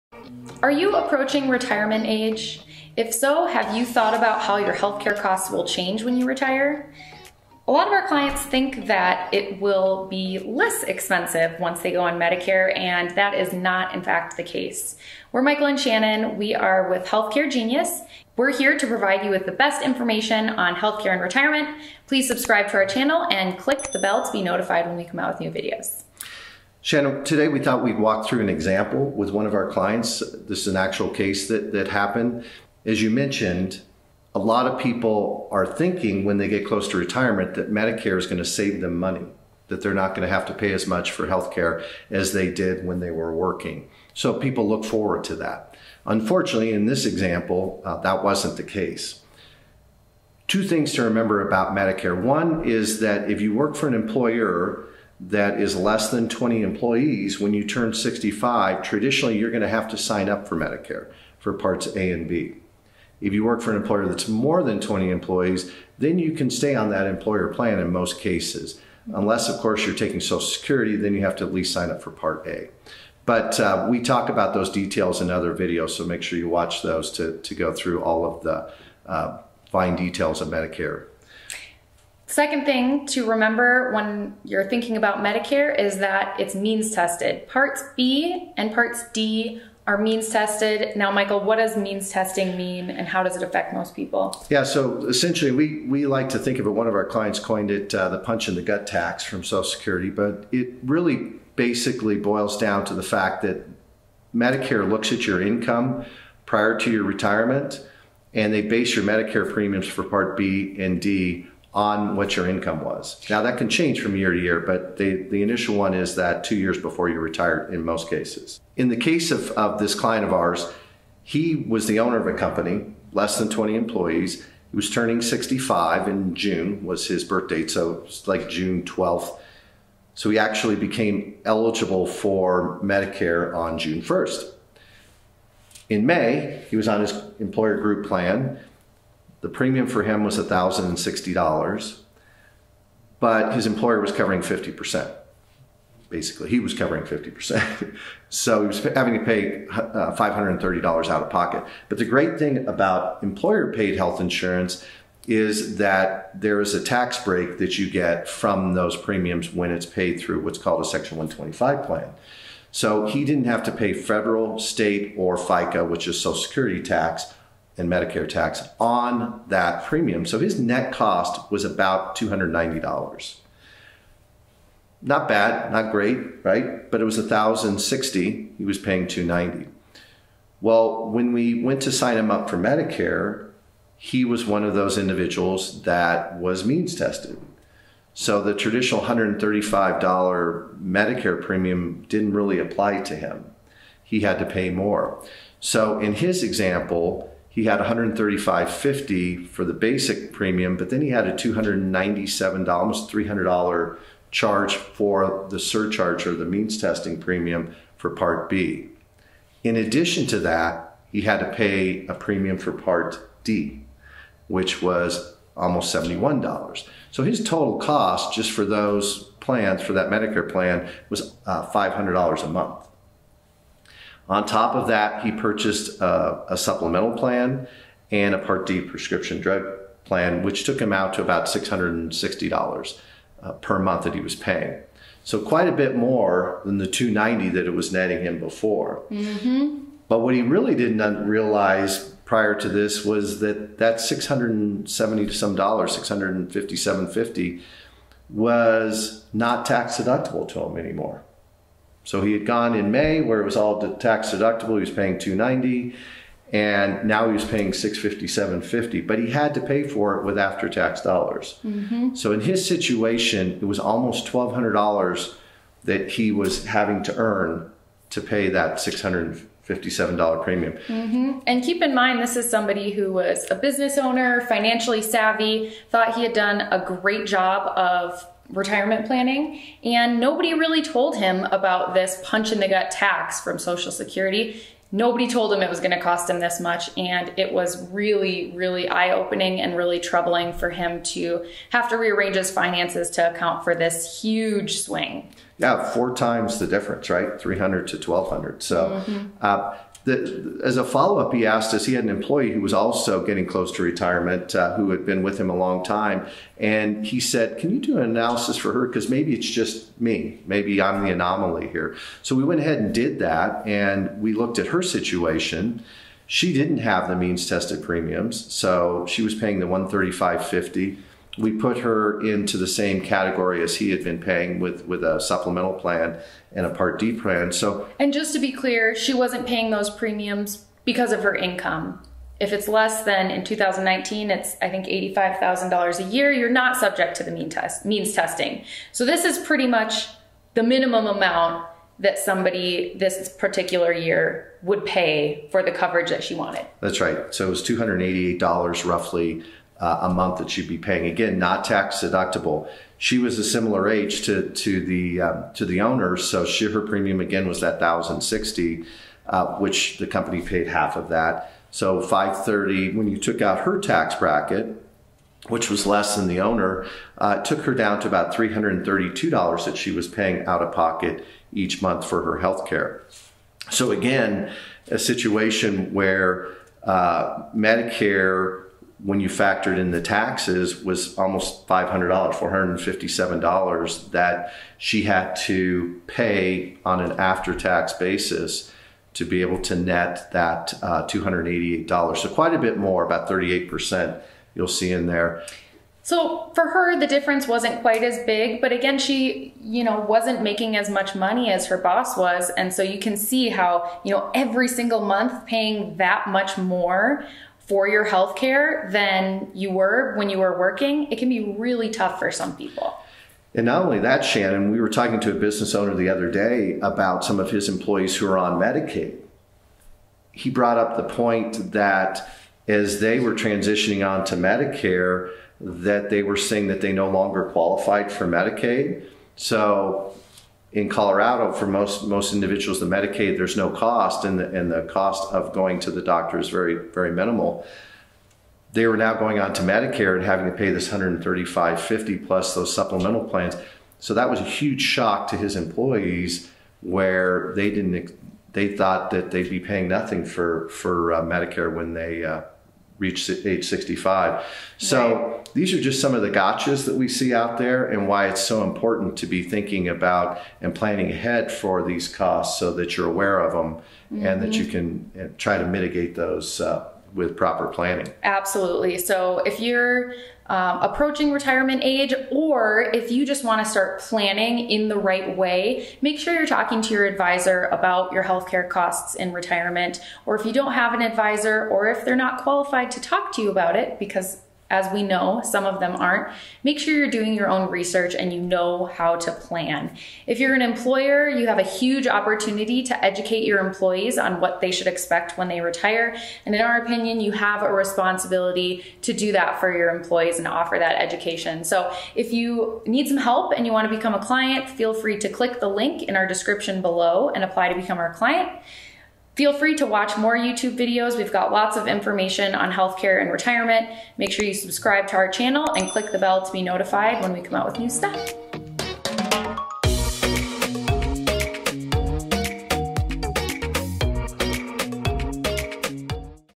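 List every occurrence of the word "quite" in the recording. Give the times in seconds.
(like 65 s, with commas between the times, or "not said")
235 s, 392 s, 397 s.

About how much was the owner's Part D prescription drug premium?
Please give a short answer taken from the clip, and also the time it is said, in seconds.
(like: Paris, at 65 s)
$71, at 215 s.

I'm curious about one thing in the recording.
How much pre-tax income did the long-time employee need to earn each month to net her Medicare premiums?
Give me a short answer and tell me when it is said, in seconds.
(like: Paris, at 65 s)
$457, at 382 s.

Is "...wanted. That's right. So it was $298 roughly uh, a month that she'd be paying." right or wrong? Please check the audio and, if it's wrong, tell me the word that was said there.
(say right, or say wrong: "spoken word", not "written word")
wrong: "288", not "298".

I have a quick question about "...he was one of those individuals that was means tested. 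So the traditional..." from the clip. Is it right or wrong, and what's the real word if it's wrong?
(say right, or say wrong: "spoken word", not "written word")
right.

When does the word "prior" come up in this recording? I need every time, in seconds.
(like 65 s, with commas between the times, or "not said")
106 s, 242 s.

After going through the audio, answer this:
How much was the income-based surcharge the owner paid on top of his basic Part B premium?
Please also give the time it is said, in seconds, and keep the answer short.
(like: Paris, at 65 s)
297, at 201 s.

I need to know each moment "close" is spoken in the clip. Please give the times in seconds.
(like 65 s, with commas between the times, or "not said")
36 s, 303 s.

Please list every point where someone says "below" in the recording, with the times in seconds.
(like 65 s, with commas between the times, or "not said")
506 s.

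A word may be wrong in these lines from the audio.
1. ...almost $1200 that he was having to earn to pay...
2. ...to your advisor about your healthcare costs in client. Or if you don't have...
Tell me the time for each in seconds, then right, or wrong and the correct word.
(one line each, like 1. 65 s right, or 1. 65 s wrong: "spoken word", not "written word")
1. 263 s right
2. 476 s wrong: "retirement", not "client".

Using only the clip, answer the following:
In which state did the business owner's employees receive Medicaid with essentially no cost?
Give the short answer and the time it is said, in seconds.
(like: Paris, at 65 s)
Colorado, at 430 s.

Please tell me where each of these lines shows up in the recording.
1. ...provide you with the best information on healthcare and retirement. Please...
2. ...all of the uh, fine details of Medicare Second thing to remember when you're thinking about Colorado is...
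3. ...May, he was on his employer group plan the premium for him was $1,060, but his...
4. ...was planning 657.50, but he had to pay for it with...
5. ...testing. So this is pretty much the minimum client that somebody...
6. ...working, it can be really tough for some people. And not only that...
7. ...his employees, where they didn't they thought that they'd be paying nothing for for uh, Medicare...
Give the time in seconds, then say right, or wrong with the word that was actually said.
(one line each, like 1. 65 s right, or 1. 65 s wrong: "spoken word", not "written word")
1. 18 s right
2. 78 s wrong: "Medicare", not "Colorado"
3. 136 s right
4. 257 s wrong: "paying", not "planning"
5. 338 s wrong: "amount", not "client"
6. 410 s right
7. 445 s right.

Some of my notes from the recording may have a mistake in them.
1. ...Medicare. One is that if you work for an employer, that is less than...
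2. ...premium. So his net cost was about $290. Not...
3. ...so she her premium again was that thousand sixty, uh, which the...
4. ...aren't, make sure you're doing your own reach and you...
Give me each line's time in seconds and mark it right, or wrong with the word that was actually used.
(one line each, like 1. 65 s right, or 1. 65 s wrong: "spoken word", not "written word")
1. 51 s right
2. 169 s right
3. 356 s right
4. 485 s wrong: "research", not "reach".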